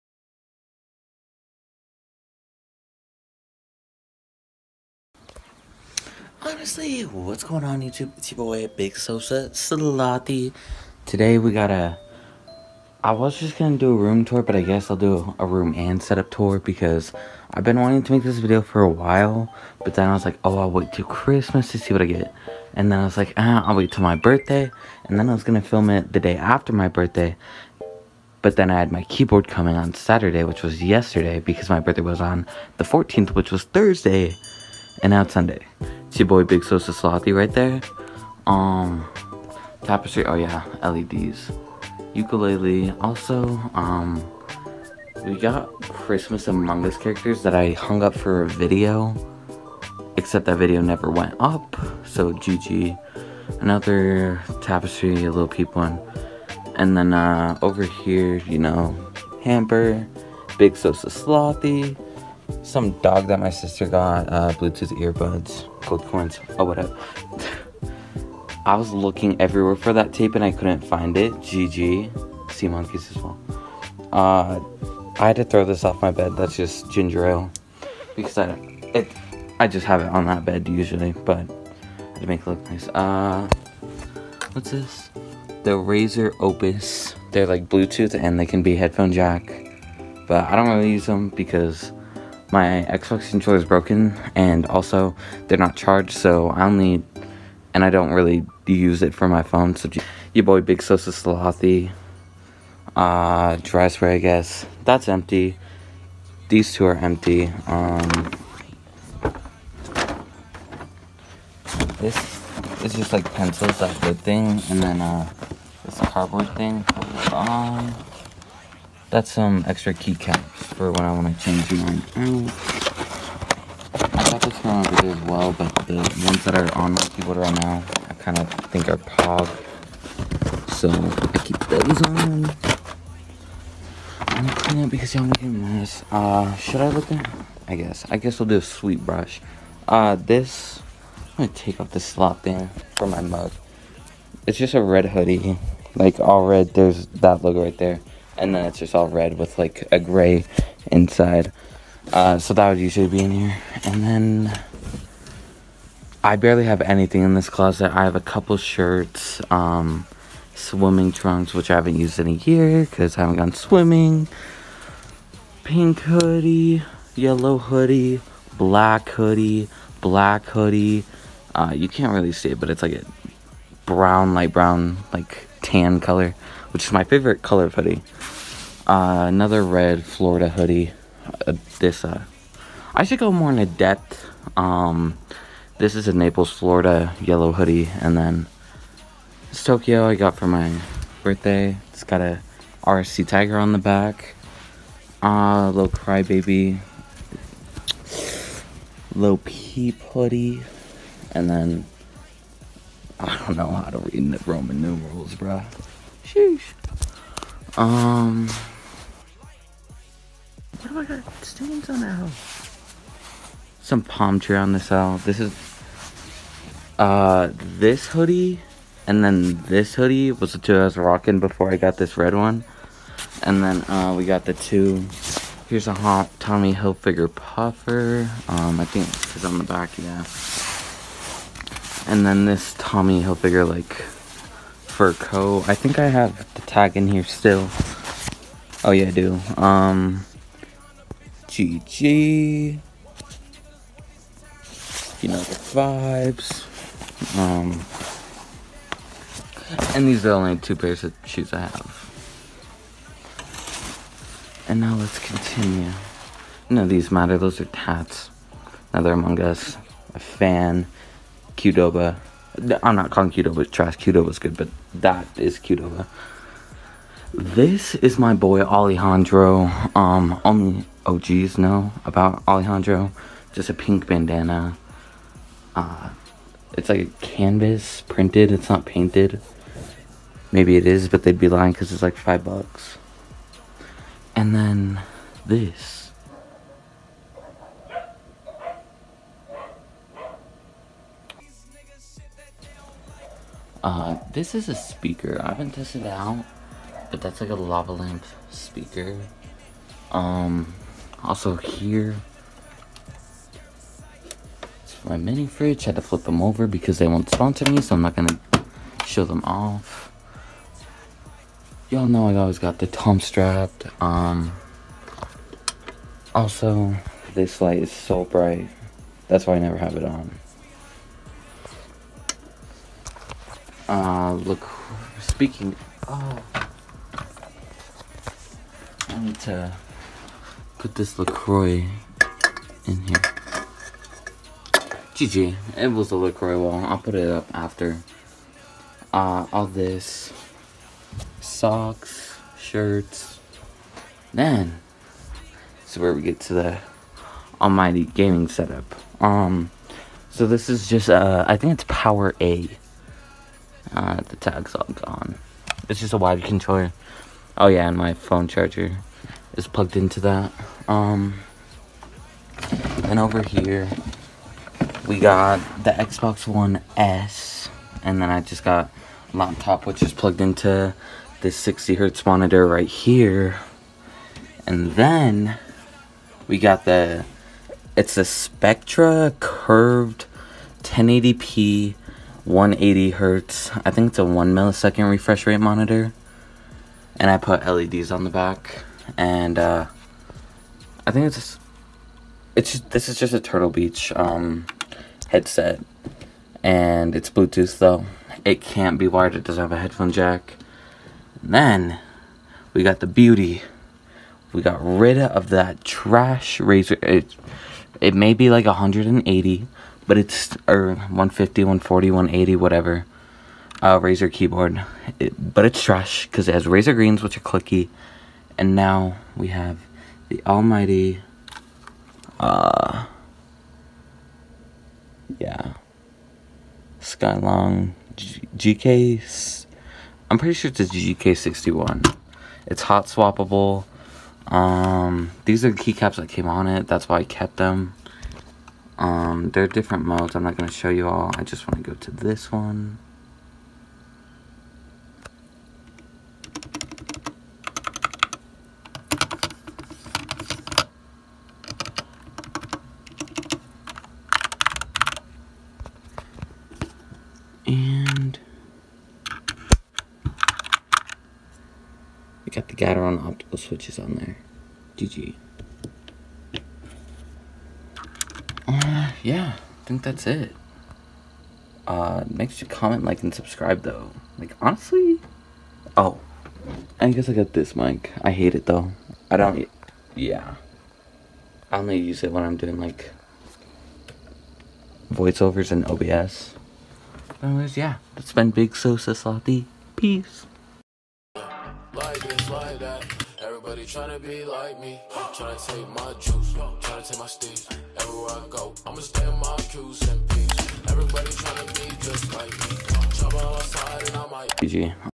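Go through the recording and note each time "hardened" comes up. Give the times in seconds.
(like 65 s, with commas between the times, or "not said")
not said.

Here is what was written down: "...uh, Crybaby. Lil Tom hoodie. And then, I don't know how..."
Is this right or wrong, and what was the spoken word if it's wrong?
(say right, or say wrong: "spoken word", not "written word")
wrong: "Peep", not "Tom".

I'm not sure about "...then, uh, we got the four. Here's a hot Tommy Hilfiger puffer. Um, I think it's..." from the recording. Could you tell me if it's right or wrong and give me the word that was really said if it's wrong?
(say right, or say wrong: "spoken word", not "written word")
wrong: "two", not "four".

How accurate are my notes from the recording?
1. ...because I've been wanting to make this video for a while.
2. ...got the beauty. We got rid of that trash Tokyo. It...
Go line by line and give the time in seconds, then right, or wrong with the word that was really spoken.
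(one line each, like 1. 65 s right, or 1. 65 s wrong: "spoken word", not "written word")
1. 16 s right
2. 402 s wrong: "Razer", not "Tokyo".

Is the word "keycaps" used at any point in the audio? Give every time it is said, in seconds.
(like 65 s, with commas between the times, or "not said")
119 s, 435 s.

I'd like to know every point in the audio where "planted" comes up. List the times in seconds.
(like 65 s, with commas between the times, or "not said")
not said.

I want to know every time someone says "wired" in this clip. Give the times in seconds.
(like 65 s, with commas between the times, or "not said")
356 s, 399 s.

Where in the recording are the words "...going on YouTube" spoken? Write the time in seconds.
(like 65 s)
7 s.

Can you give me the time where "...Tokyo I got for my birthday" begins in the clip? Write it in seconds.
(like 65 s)
189 s.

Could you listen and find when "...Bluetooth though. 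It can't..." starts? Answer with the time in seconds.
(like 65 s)
397 s.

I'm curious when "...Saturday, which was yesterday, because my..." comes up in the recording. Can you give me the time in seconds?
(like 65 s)
29 s.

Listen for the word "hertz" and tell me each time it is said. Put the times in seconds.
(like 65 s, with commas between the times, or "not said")
371 s, 383 s.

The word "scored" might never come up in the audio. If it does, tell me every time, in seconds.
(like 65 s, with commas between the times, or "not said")
not said.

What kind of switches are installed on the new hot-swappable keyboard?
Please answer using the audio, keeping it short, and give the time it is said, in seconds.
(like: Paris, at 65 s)
Gateron optical, at 462 s.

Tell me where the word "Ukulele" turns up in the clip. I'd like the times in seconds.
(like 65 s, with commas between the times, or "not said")
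42 s.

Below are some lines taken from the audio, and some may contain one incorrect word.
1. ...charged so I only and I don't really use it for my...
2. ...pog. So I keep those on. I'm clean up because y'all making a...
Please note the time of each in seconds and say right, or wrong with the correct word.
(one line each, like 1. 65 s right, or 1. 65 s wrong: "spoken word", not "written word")
1. 95 s right
2. 128 s right.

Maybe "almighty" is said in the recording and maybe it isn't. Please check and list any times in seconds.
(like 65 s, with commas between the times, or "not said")
347 s, 420 s.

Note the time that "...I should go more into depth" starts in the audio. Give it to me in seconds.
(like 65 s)
182 s.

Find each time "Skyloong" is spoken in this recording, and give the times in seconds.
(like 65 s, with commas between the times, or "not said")
426 s.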